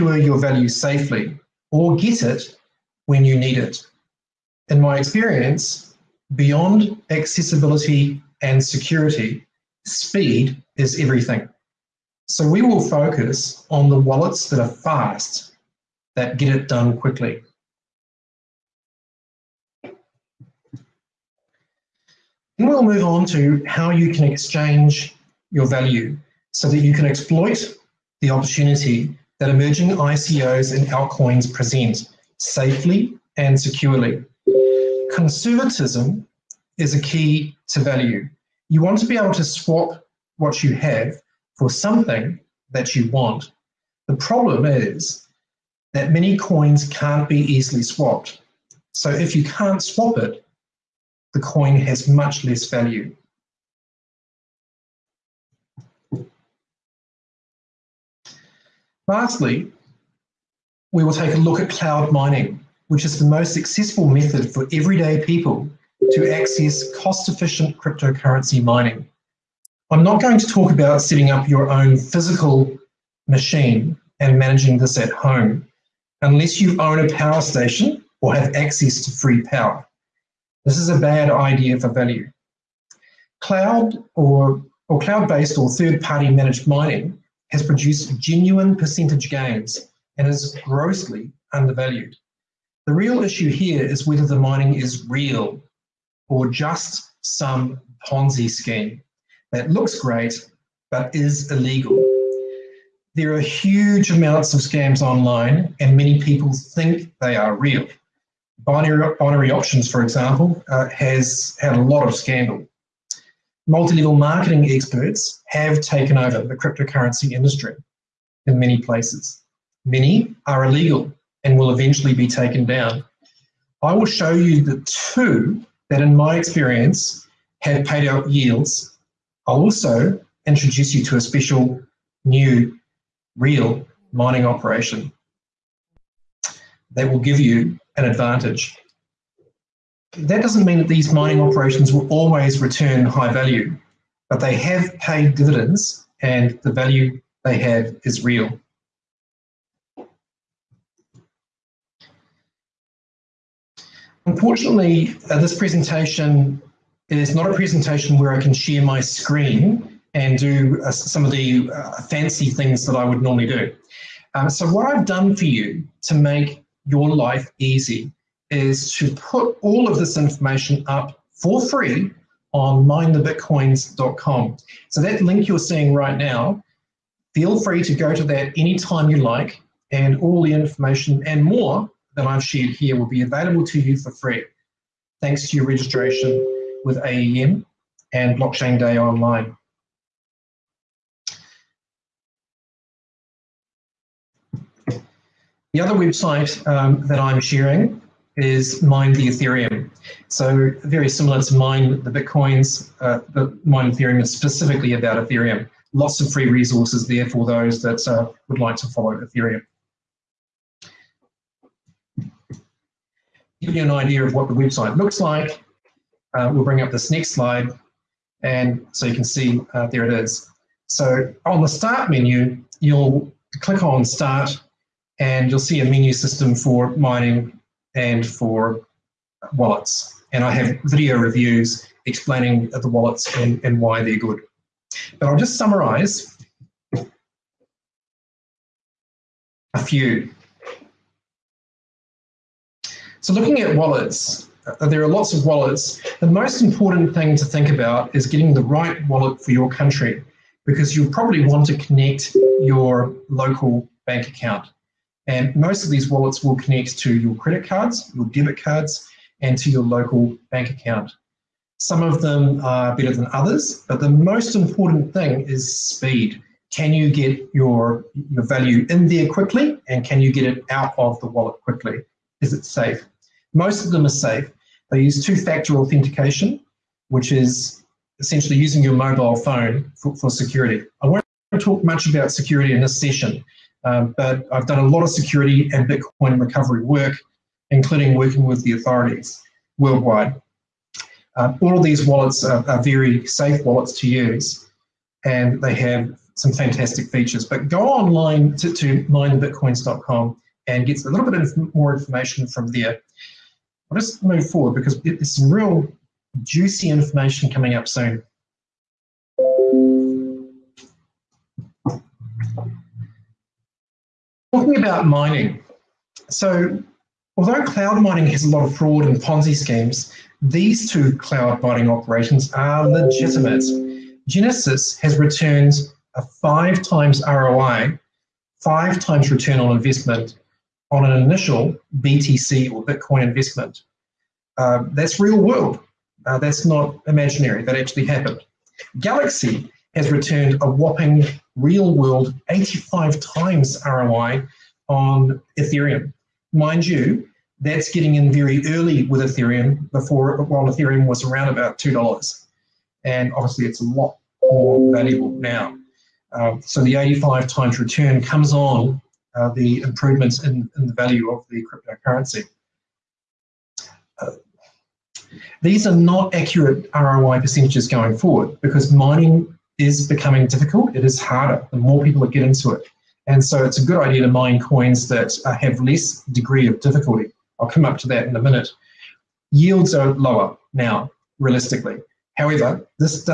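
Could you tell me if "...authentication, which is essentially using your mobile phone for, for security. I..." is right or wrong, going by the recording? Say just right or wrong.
right.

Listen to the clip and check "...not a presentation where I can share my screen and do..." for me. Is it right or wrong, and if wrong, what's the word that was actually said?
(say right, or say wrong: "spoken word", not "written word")
right.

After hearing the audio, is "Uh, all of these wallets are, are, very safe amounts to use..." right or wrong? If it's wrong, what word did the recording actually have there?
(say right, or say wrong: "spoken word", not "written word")
wrong: "wallets", not "amounts".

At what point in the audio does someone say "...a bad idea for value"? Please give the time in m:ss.
1:20.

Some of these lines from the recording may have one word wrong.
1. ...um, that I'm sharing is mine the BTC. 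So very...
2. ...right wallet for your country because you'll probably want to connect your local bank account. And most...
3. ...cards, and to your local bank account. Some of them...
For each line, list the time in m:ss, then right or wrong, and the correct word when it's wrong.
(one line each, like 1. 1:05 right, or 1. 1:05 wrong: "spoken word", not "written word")
1. 3:16 wrong: "Ethereum", not "BTC"
2. 4:08 right
3. 4:18 right.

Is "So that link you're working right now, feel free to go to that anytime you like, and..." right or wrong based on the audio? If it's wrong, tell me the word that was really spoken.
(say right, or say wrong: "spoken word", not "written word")
wrong: "seeing", not "working".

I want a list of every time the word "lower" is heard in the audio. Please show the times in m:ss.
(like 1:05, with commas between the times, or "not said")
6:20.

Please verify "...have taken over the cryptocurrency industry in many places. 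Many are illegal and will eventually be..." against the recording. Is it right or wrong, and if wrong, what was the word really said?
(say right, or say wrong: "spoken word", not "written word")
right.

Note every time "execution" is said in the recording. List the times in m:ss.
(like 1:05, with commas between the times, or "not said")
not said.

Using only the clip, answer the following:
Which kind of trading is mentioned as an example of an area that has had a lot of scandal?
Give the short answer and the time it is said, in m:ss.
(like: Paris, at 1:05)
binary options, at 1:49.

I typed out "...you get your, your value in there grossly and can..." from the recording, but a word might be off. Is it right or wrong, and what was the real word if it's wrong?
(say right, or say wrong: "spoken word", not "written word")
wrong: "quickly", not "grossly".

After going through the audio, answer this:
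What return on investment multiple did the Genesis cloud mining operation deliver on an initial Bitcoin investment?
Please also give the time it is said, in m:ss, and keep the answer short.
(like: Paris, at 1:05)
5 times, at 5:26.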